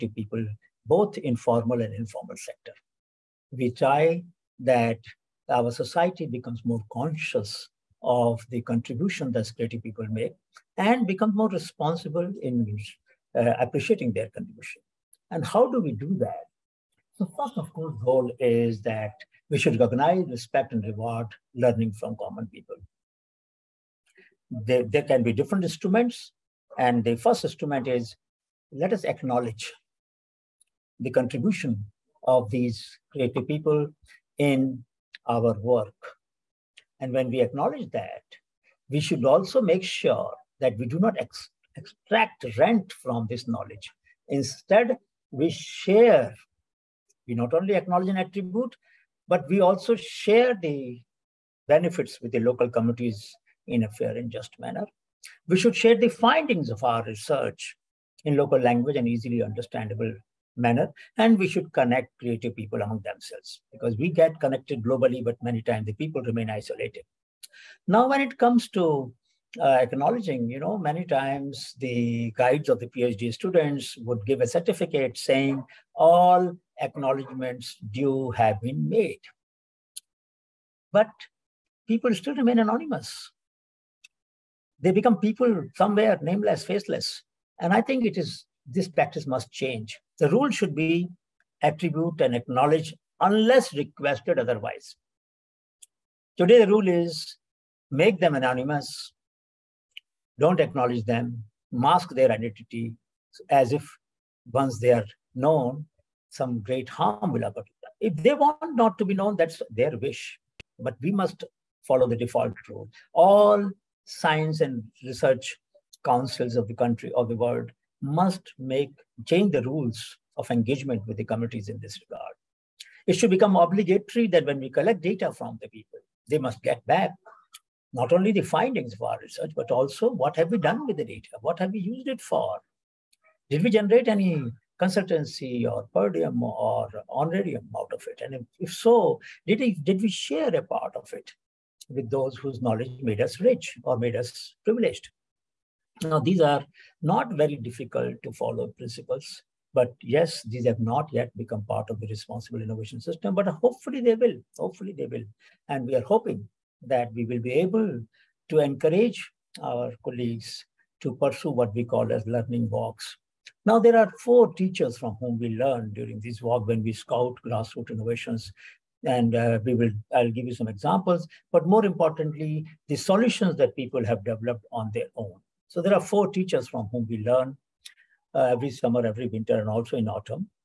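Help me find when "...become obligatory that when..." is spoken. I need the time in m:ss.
2:03.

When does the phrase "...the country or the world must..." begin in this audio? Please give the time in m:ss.
1:56.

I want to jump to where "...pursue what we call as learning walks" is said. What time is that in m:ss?
2:41.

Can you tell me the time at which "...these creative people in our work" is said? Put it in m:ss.
0:32.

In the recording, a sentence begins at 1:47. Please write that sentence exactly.
If they want not to be known, that's their wish.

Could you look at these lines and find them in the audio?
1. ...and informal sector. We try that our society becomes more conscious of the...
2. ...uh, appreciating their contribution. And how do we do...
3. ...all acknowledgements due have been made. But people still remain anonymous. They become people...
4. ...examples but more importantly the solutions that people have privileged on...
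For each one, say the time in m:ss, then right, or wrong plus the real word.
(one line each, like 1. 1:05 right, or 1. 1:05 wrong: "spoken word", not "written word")
1. 0:01 right
2. 0:13 right
3. 1:15 right
4. 2:50 wrong: "developed", not "privileged".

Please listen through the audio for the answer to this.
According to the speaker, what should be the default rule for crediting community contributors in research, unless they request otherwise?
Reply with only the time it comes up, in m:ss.
1:31.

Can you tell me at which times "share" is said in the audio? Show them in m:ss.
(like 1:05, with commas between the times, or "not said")
0:45, 0:49, 0:55, 2:20.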